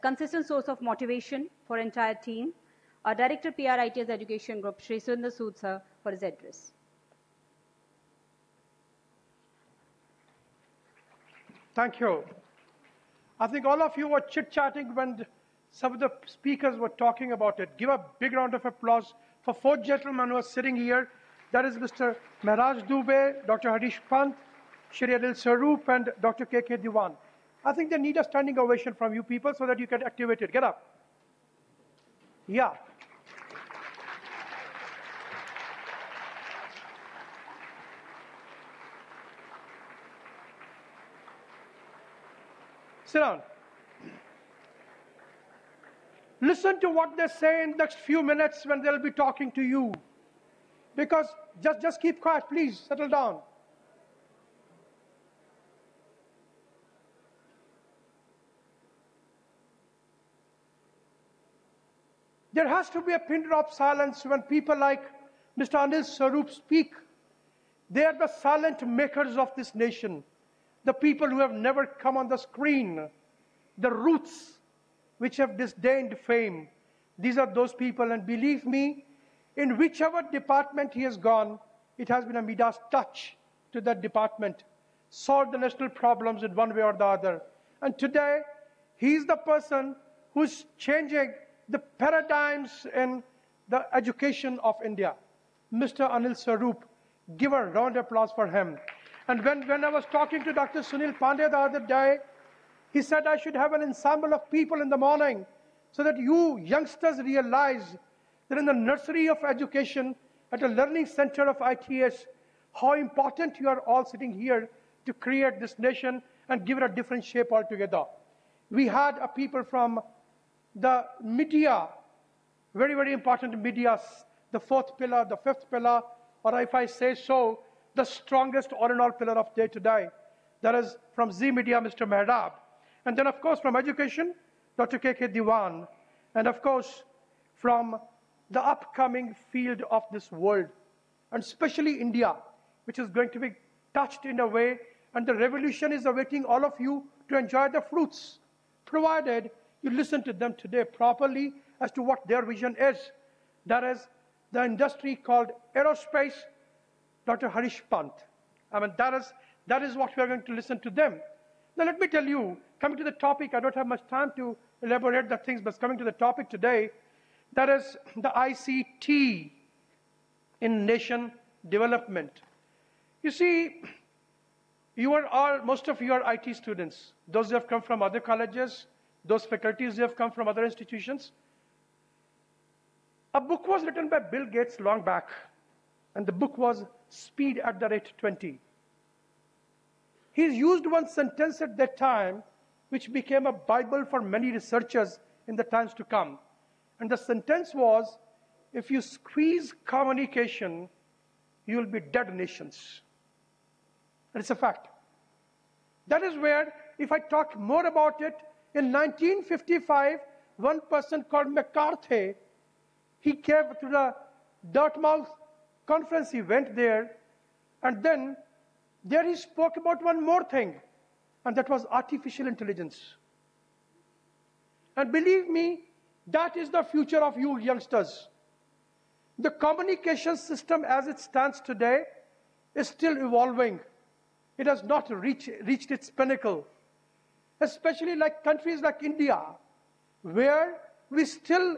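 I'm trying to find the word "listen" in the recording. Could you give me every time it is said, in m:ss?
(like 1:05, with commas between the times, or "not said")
0:46, 2:29, 2:40.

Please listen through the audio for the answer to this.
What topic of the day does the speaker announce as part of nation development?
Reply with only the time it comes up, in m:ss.
2:48.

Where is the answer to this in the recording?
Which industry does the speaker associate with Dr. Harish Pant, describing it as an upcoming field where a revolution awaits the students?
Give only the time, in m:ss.
2:35.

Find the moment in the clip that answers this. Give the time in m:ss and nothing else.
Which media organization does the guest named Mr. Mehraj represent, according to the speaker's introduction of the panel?
2:11.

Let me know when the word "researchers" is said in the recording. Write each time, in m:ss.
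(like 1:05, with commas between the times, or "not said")
3:14.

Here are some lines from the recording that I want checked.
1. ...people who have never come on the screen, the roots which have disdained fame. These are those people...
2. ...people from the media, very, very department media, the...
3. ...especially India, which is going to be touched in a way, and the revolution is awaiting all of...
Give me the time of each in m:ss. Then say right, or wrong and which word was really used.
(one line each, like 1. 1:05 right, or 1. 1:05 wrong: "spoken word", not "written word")
1. 1:10 right
2. 1:59 wrong: "important", not "department"
3. 2:21 right.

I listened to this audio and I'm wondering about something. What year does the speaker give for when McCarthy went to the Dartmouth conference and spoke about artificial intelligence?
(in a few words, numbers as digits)
1955.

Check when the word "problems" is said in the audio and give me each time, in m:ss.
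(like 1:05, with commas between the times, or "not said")
1:25.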